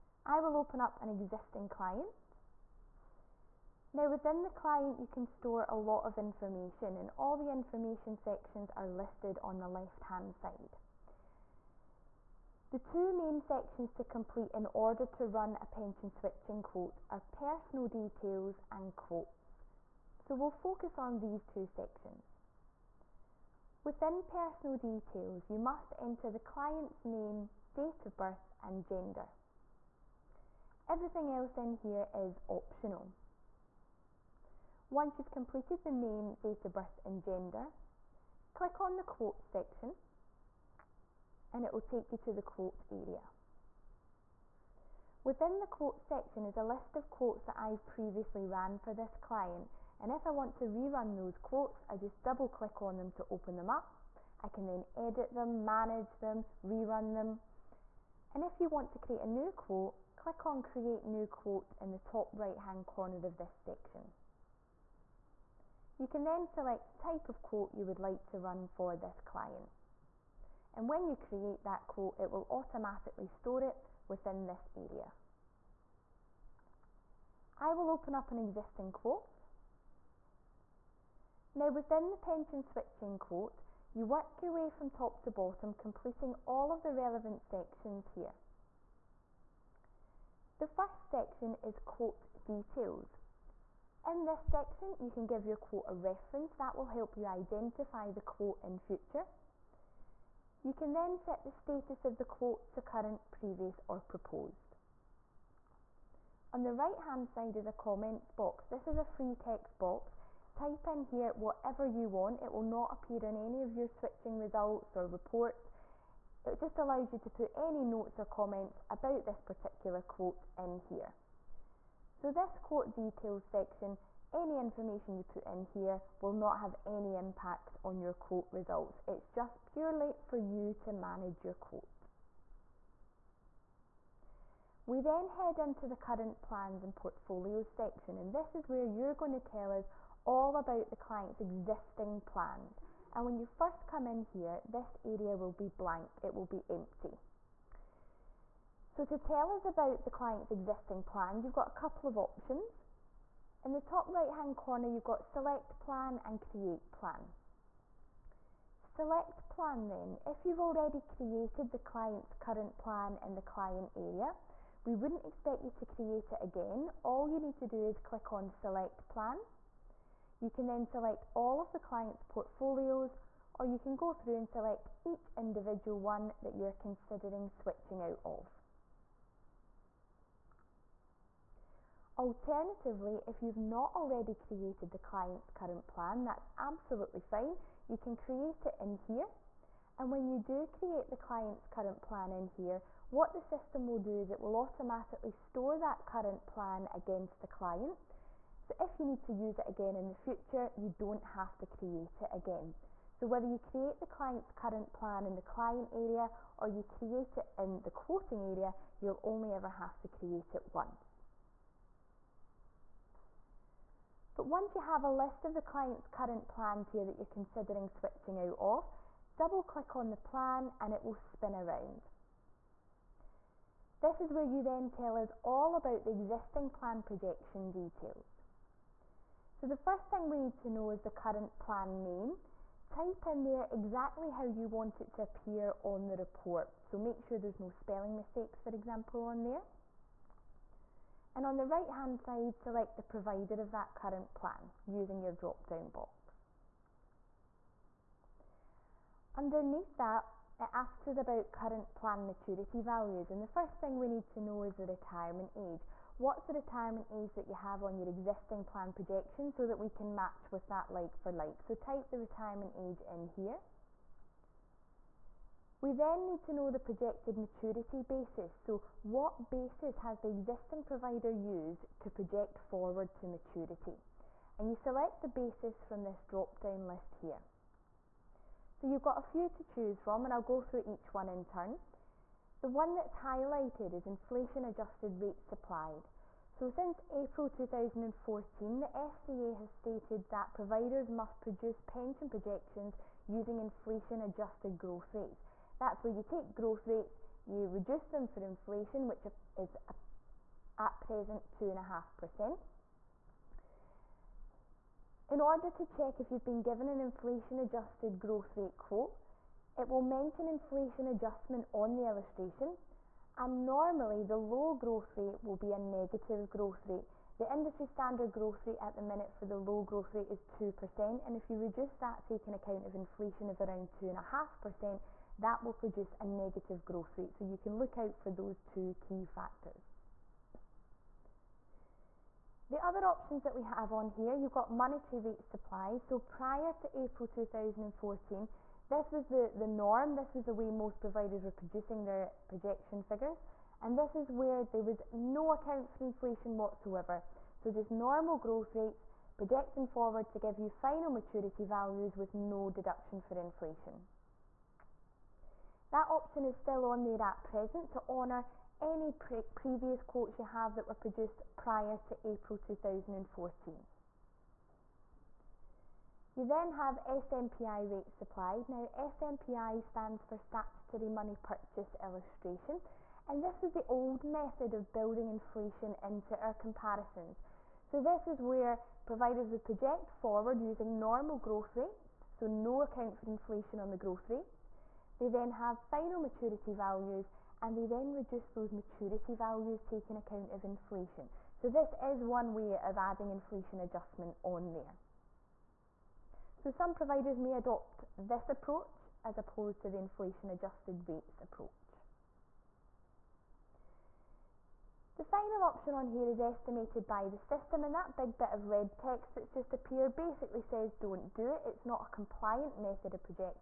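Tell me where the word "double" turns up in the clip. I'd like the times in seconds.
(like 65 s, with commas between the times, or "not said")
52 s, 219 s.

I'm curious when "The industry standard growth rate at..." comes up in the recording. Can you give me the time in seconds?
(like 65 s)
317 s.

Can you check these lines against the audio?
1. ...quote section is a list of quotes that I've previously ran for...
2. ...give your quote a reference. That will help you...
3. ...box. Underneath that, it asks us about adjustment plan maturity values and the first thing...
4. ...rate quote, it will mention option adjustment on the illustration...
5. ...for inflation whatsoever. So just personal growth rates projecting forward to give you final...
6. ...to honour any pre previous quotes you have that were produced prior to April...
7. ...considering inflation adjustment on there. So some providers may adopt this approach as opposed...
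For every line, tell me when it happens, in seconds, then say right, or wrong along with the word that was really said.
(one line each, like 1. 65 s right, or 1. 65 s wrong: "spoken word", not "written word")
1. 45 s right
2. 95 s right
3. 245 s wrong: "current", not "adjustment"
4. 308 s wrong: "inflation", not "option"
5. 345 s wrong: "normal", not "personal"
6. 357 s right
7. 392 s wrong: "adding", not "considering".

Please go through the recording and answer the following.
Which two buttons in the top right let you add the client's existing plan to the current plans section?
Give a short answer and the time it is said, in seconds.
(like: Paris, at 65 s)
Select plan and create plan, at 155 s.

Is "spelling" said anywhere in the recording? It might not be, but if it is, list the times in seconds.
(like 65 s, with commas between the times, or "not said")
237 s.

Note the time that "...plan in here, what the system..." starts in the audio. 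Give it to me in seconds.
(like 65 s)
192 s.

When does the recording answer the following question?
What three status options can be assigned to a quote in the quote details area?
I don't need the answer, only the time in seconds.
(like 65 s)
102 s.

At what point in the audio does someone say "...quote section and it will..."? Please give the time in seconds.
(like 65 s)
39 s.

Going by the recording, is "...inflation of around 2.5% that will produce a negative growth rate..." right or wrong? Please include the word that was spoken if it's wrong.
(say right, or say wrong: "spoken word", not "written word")
right.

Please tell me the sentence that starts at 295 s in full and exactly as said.
That's where you take growth rates, you reduce them for inflation, which is at present 2.5%.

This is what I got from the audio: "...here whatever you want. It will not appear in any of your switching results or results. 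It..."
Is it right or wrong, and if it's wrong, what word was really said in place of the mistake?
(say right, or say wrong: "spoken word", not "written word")
wrong: "reports", not "results".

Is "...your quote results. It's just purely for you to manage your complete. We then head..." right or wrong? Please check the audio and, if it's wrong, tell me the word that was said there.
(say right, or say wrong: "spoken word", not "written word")
wrong: "quote", not "complete".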